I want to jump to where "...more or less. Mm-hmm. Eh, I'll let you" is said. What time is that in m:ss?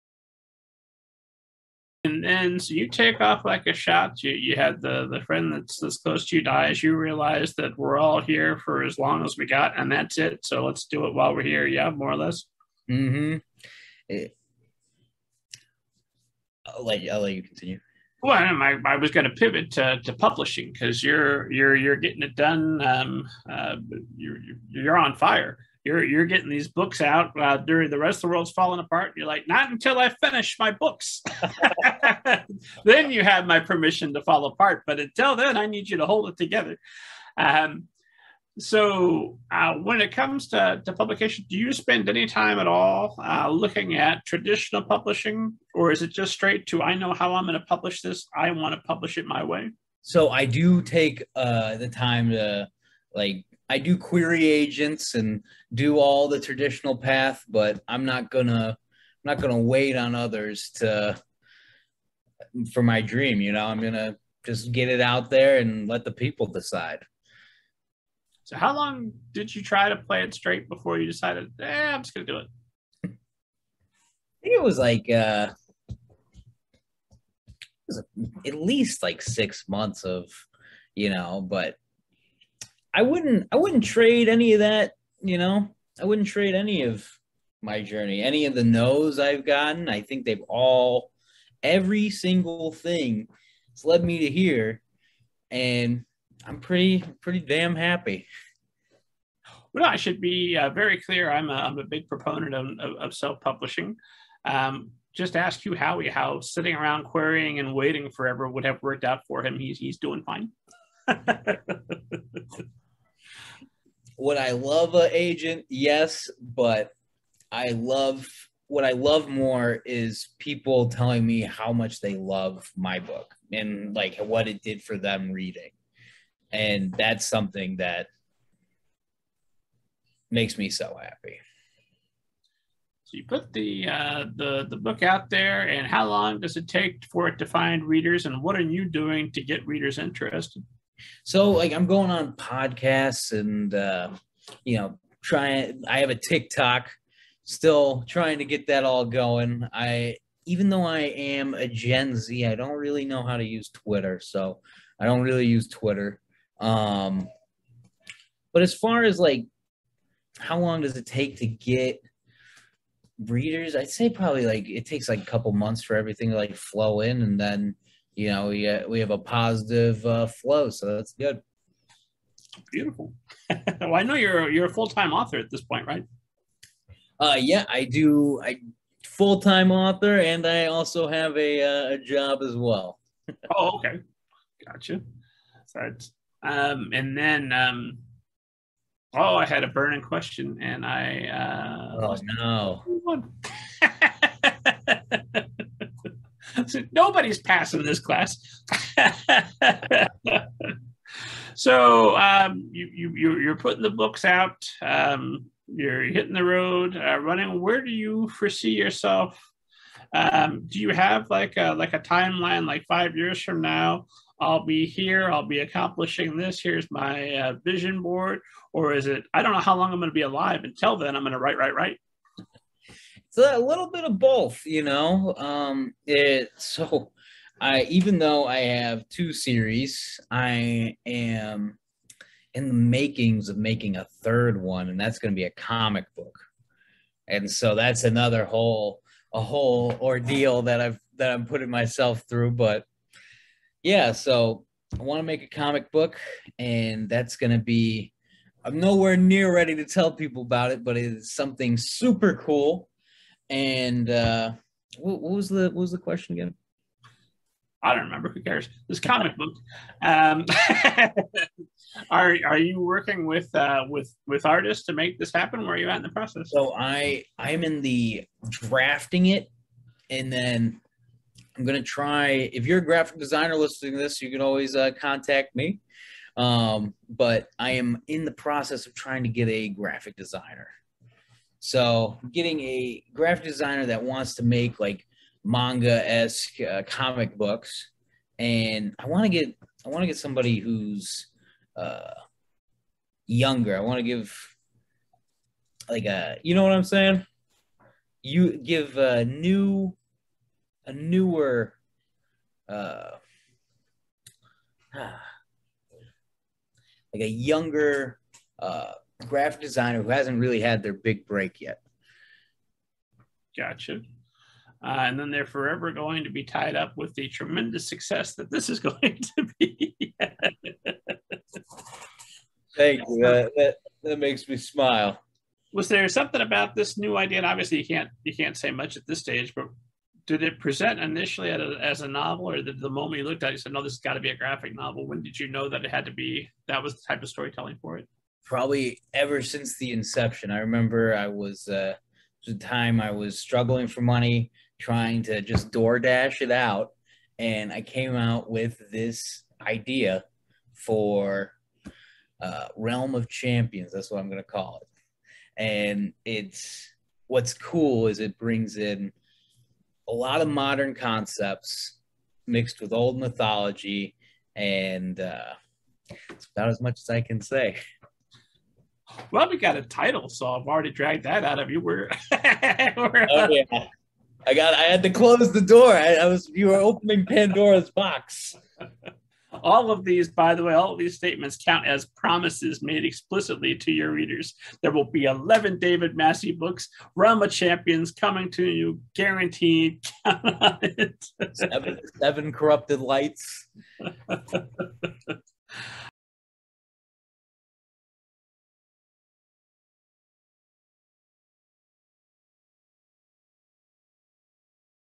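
0:11.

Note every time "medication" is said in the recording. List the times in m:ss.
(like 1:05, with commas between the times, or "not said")
not said.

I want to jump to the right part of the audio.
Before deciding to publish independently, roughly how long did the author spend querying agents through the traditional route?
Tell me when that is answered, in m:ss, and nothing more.
1:19.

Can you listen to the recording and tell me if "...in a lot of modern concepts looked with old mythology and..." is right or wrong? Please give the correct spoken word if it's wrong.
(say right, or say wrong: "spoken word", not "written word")
wrong: "mixed", not "looked".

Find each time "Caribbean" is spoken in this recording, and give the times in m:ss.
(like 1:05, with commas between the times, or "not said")
not said.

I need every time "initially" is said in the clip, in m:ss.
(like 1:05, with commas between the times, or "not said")
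5:30.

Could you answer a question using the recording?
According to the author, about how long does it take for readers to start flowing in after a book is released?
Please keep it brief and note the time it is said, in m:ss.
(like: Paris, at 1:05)
A couple months, at 2:45.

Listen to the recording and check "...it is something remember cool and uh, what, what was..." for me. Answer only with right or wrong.
wrong.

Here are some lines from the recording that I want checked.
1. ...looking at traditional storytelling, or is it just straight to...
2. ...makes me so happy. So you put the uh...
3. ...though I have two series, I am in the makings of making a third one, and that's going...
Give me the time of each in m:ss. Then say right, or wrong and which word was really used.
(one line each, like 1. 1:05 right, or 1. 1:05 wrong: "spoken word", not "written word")
1. 0:43 wrong: "publishing", not "storytelling"
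2. 2:10 right
3. 3:48 right.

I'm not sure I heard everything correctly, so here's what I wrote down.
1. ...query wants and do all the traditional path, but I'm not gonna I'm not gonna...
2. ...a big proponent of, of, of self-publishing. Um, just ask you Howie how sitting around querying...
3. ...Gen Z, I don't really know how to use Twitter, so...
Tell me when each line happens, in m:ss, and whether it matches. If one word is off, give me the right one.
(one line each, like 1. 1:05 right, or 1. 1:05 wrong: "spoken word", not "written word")
1. 0:53 wrong: "agents", not "wants"
2. 1:41 right
3. 2:31 right.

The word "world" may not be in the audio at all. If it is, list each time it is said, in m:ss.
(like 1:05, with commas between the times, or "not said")
0:28.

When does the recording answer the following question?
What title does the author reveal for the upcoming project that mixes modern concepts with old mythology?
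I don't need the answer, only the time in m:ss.
5:52.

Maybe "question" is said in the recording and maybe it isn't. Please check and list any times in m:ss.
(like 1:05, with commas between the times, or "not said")
3:10, 4:15.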